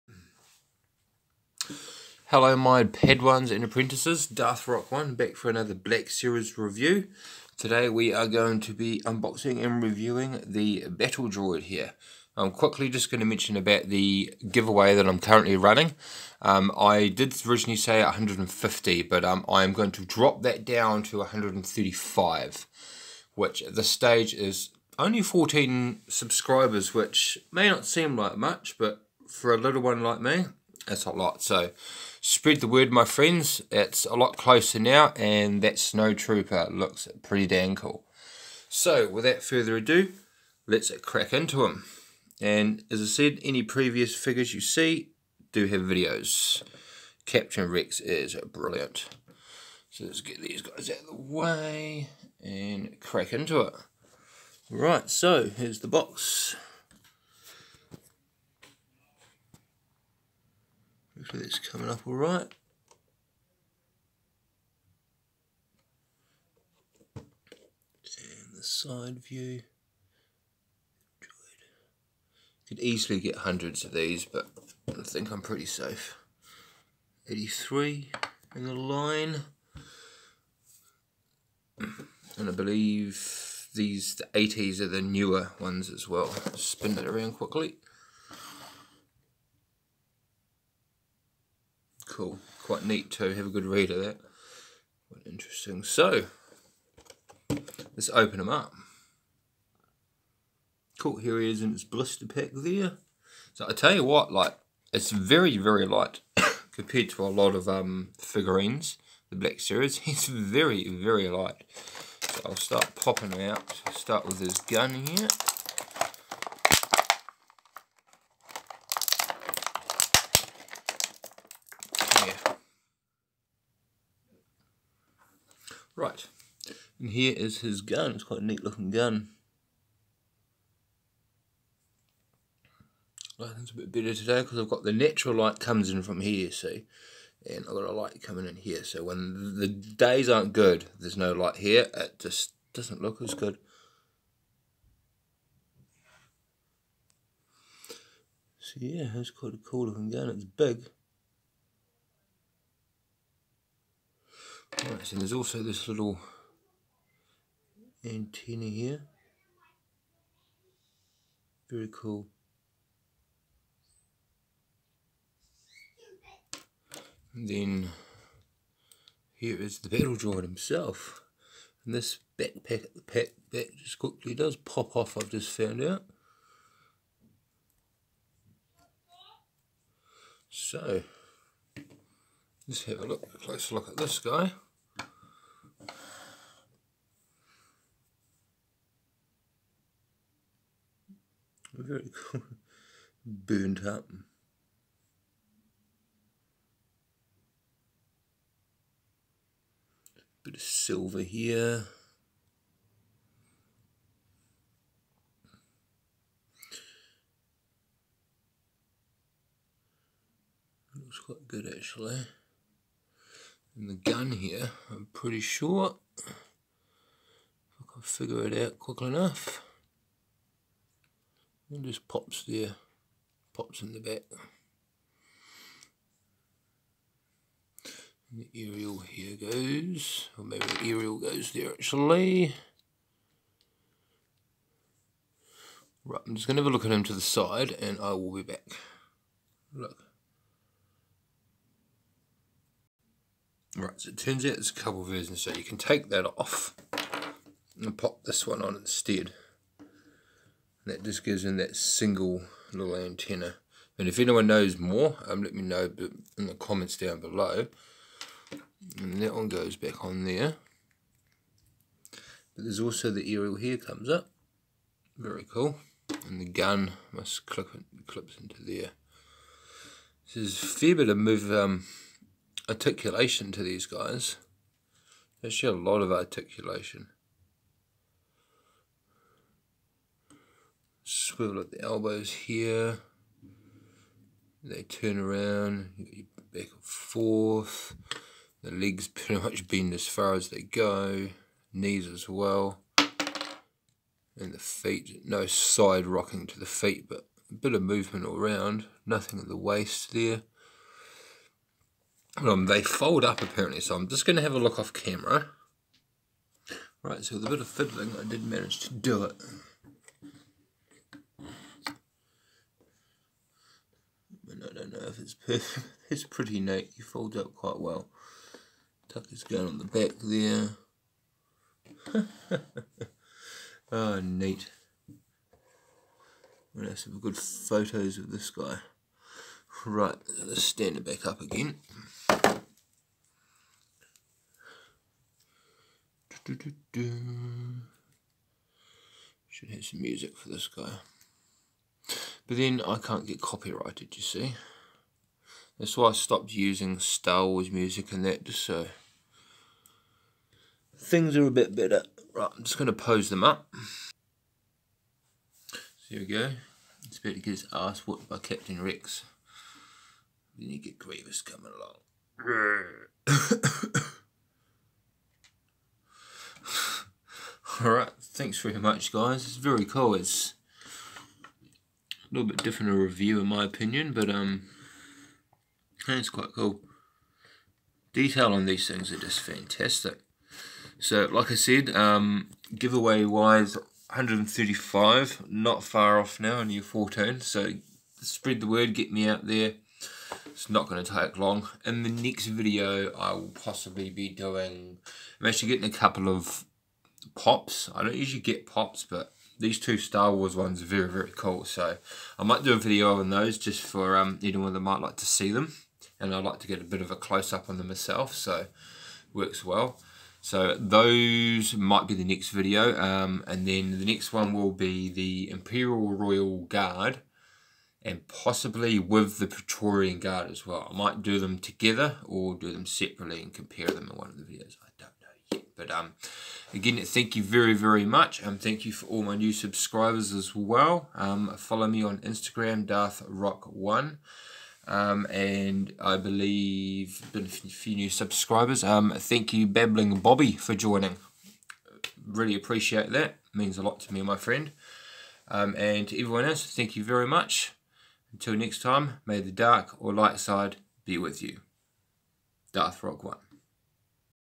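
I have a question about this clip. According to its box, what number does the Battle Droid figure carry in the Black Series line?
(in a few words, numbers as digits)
83.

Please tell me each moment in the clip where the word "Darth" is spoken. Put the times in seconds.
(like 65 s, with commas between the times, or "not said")
4 s, 432 s, 452 s.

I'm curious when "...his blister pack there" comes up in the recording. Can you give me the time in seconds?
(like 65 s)
101 s.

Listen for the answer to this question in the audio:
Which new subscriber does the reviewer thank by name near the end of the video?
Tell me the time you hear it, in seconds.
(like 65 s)
439 s.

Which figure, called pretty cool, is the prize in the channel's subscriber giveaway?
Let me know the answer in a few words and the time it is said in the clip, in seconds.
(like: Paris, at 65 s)
Snow Trooper, at 35 s.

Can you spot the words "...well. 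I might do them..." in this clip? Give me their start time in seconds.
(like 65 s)
420 s.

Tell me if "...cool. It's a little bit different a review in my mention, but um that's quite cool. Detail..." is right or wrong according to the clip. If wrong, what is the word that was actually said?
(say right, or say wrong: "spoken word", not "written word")
wrong: "opinion", not "mention".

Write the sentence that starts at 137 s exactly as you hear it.
And I've got a light coming in here.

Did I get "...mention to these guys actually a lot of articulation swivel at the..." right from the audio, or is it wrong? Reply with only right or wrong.
wrong.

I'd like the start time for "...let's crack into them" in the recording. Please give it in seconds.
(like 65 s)
40 s.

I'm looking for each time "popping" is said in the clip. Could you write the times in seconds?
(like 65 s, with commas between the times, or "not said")
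112 s.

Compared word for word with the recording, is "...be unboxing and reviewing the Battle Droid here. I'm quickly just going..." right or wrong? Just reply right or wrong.
right.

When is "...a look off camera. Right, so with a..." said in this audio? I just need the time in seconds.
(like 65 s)
304 s.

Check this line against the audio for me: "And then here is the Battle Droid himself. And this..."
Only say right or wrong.
right.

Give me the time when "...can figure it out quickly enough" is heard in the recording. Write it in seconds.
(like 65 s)
217 s.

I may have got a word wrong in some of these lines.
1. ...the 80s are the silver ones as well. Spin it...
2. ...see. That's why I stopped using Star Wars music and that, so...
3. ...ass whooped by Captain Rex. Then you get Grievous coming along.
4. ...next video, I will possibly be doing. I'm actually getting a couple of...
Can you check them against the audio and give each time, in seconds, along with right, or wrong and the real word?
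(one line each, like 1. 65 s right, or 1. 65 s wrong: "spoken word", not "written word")
1. 84 s wrong: "newer", not "silver"
2. 344 s right
3. 357 s right
4. 392 s right.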